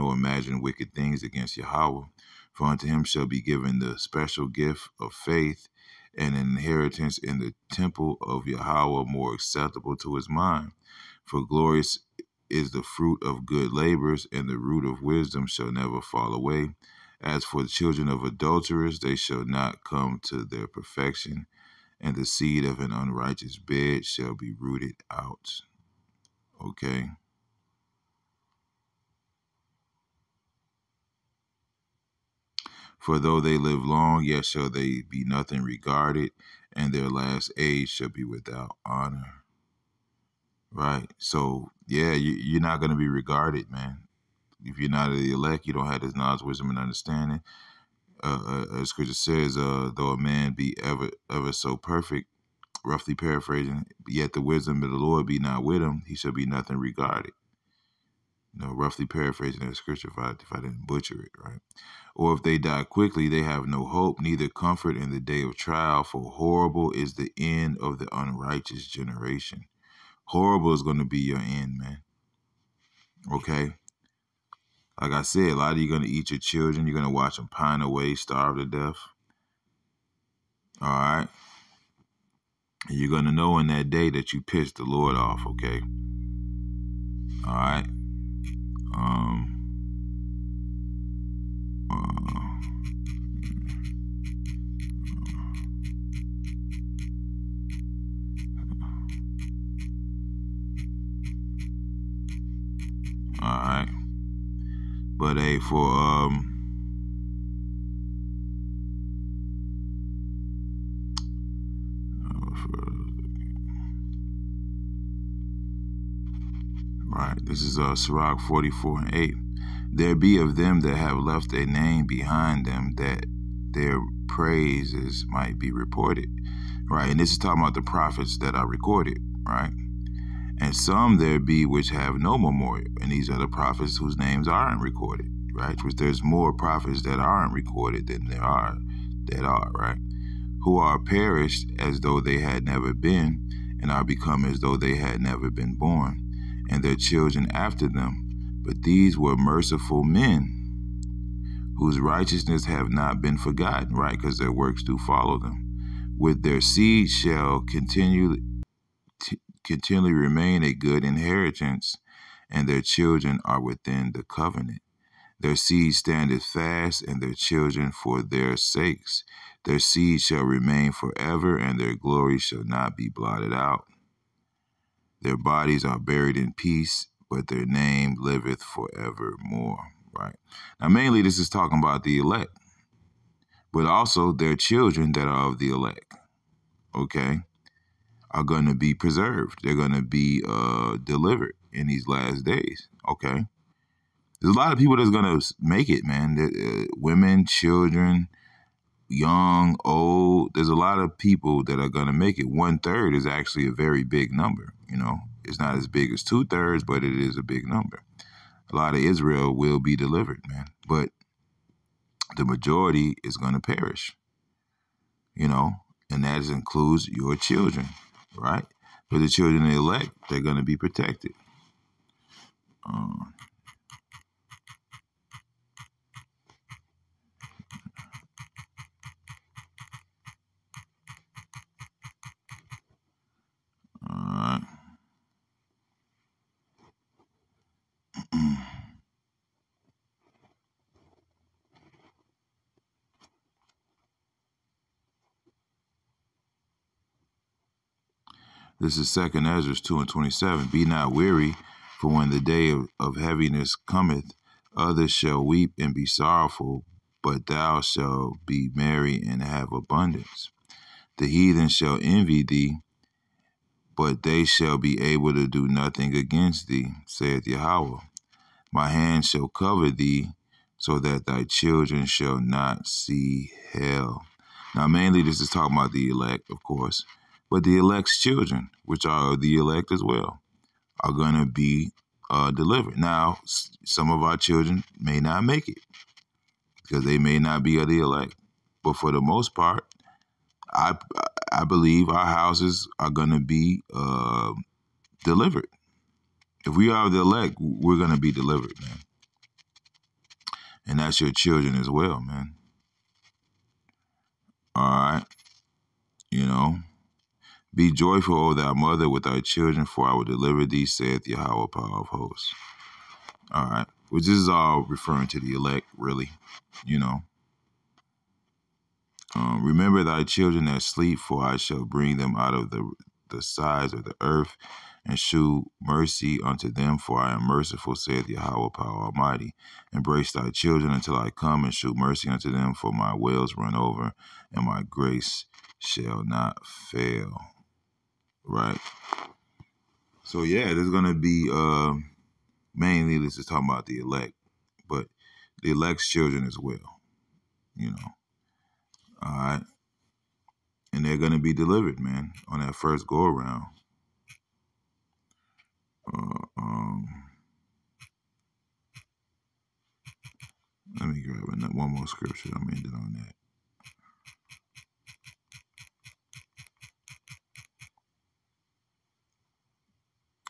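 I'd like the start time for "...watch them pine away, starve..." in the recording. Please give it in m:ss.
1:17.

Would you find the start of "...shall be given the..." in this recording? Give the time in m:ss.
0:03.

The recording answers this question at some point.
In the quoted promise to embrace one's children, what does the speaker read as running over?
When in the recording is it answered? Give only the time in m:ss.
5:32.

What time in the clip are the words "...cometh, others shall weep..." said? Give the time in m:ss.
4:13.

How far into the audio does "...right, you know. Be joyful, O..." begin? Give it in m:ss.
5:04.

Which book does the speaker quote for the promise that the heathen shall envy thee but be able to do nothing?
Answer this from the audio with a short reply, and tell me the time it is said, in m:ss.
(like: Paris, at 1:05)
Second Ezra, at 4:09.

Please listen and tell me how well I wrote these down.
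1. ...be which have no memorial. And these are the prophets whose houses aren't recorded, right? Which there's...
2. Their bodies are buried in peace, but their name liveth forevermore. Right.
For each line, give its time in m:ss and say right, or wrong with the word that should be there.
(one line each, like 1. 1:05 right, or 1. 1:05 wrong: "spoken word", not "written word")
1. 2:11 wrong: "names", not "houses"
2. 2:55 right.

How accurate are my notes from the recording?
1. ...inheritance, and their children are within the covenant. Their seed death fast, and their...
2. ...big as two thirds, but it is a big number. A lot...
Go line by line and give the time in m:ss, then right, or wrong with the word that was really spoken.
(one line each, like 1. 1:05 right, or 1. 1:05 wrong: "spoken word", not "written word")
1. 2:41 wrong: "standeth", not "death"
2. 3:25 right.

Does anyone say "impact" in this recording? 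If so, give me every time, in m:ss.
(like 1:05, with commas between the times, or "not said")
not said.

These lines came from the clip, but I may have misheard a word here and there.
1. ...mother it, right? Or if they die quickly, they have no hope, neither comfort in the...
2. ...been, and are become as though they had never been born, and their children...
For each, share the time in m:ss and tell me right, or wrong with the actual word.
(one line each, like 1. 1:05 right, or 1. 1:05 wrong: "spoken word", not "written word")
1. 1:00 wrong: "butcher", not "mother"
2. 2:22 right.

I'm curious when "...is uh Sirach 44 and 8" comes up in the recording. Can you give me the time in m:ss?
1:57.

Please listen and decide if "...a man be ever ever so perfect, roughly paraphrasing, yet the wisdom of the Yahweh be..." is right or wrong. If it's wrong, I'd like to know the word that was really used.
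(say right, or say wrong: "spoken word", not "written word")
wrong: "Lord", not "Yahweh".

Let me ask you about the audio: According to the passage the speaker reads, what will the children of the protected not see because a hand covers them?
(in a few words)
hell.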